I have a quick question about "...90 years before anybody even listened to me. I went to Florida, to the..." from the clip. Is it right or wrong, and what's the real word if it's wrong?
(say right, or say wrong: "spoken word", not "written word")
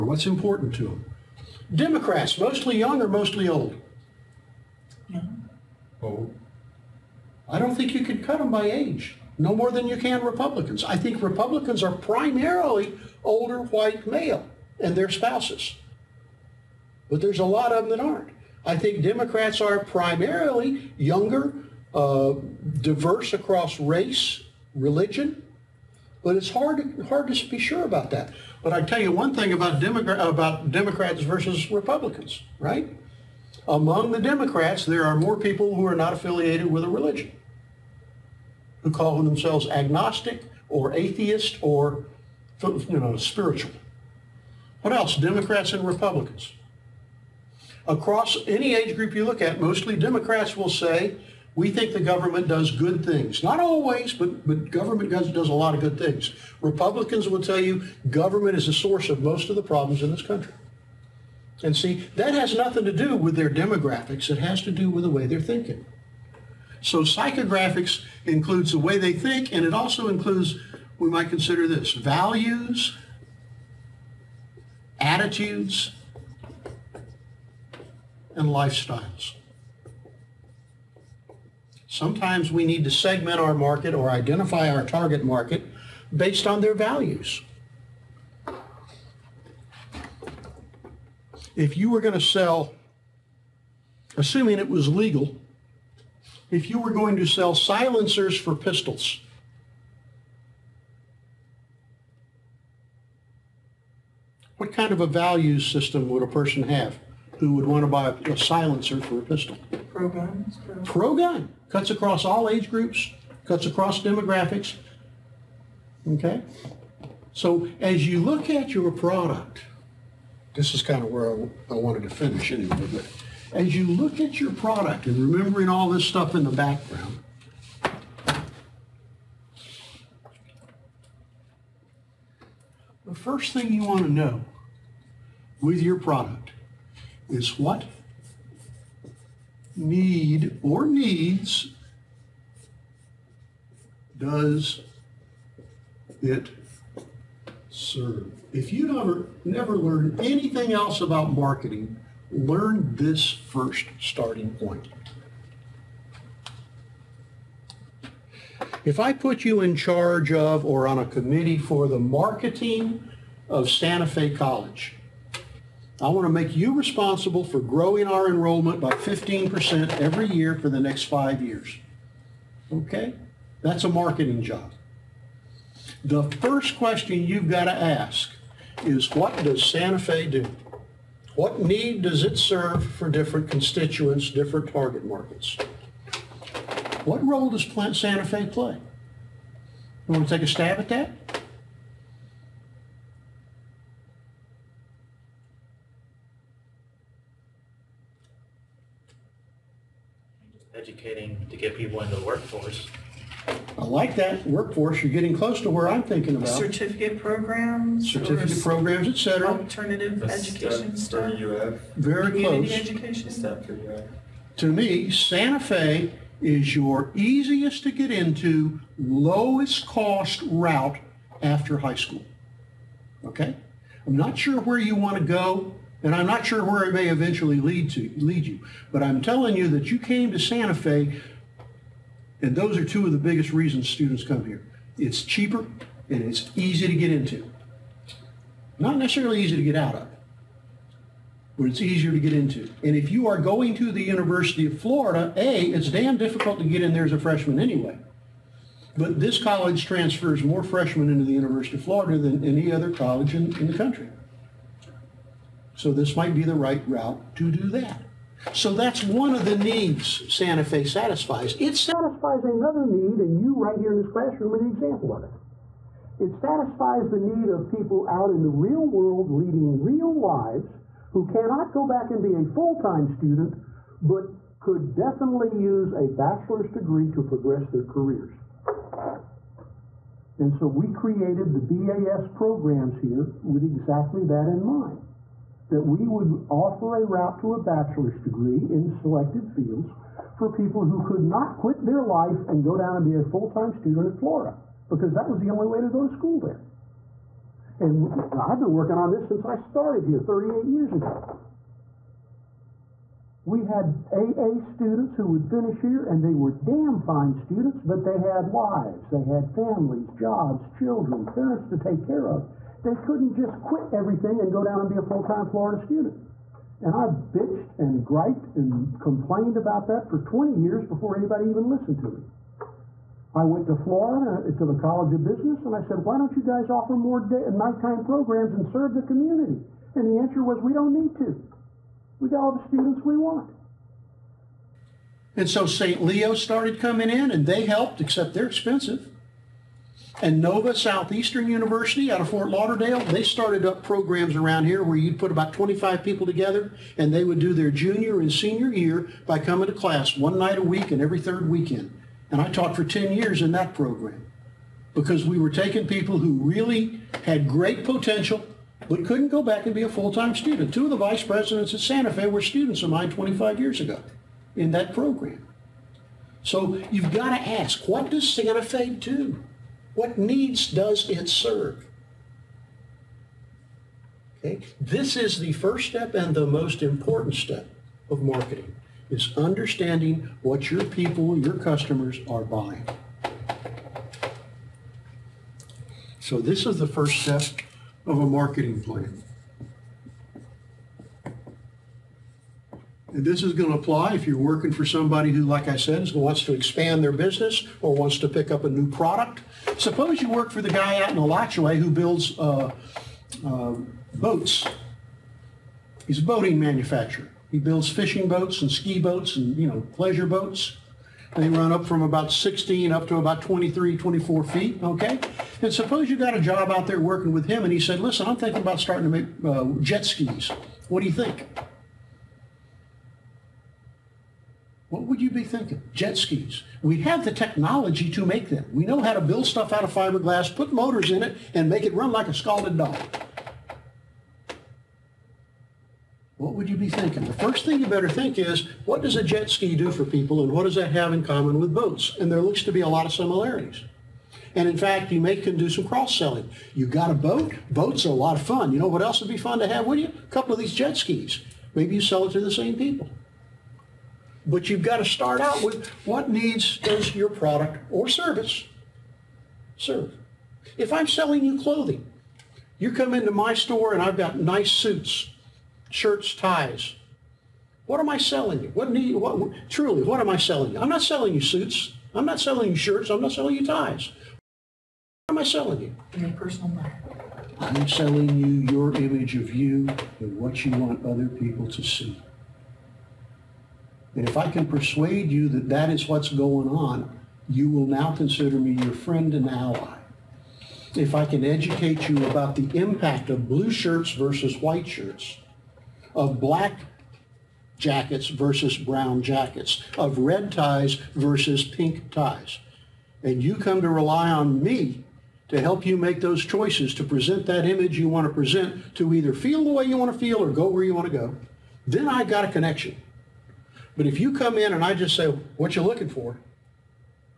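wrong: "20", not "90".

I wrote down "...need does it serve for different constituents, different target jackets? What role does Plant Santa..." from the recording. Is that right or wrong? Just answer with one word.
wrong.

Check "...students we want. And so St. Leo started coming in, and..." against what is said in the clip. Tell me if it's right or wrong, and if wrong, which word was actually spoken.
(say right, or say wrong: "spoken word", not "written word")
right.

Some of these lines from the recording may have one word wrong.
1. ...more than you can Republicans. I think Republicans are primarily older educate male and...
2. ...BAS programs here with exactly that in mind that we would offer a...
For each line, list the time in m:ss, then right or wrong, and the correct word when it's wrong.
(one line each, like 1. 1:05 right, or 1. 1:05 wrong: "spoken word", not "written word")
1. 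0:09 wrong: "white", not "educate"
2. 4:42 right.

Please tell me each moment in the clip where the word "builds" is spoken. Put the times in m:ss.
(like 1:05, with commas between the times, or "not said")
6:41, 6:47, 7:09.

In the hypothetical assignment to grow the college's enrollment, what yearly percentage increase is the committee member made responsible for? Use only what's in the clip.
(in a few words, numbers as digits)
15%.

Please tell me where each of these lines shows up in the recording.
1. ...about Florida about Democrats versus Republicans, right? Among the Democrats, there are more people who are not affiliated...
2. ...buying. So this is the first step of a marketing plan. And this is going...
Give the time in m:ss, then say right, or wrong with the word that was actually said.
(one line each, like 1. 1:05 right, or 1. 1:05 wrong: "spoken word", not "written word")
1. 0:29 wrong: "Democrat", not "Florida"
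2. 6:22 right.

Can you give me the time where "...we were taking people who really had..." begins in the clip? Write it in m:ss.
5:55.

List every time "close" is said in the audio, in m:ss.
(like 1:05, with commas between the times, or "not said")
3:25, 3:32.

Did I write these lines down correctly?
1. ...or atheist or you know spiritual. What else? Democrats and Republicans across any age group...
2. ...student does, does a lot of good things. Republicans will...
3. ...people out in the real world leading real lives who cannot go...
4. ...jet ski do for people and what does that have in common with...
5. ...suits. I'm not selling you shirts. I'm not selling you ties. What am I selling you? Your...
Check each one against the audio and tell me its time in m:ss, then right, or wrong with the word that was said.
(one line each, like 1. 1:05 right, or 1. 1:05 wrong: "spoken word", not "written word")
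1. 0:40 right
2. 0:54 wrong: "government", not "student"
3. 4:27 right
4. 7:19 right
5. 7:51 right.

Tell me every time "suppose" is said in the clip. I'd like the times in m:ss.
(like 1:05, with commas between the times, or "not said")
6:39, 6:55.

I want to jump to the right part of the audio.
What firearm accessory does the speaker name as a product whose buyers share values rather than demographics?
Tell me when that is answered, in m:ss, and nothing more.
1:37.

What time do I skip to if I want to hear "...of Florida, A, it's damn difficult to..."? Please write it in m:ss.
4:04.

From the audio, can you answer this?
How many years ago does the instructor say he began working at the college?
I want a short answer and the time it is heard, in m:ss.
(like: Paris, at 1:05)
38, at 5:00.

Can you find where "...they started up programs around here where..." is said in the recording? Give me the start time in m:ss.
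5:43.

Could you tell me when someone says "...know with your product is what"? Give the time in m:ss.
2:14.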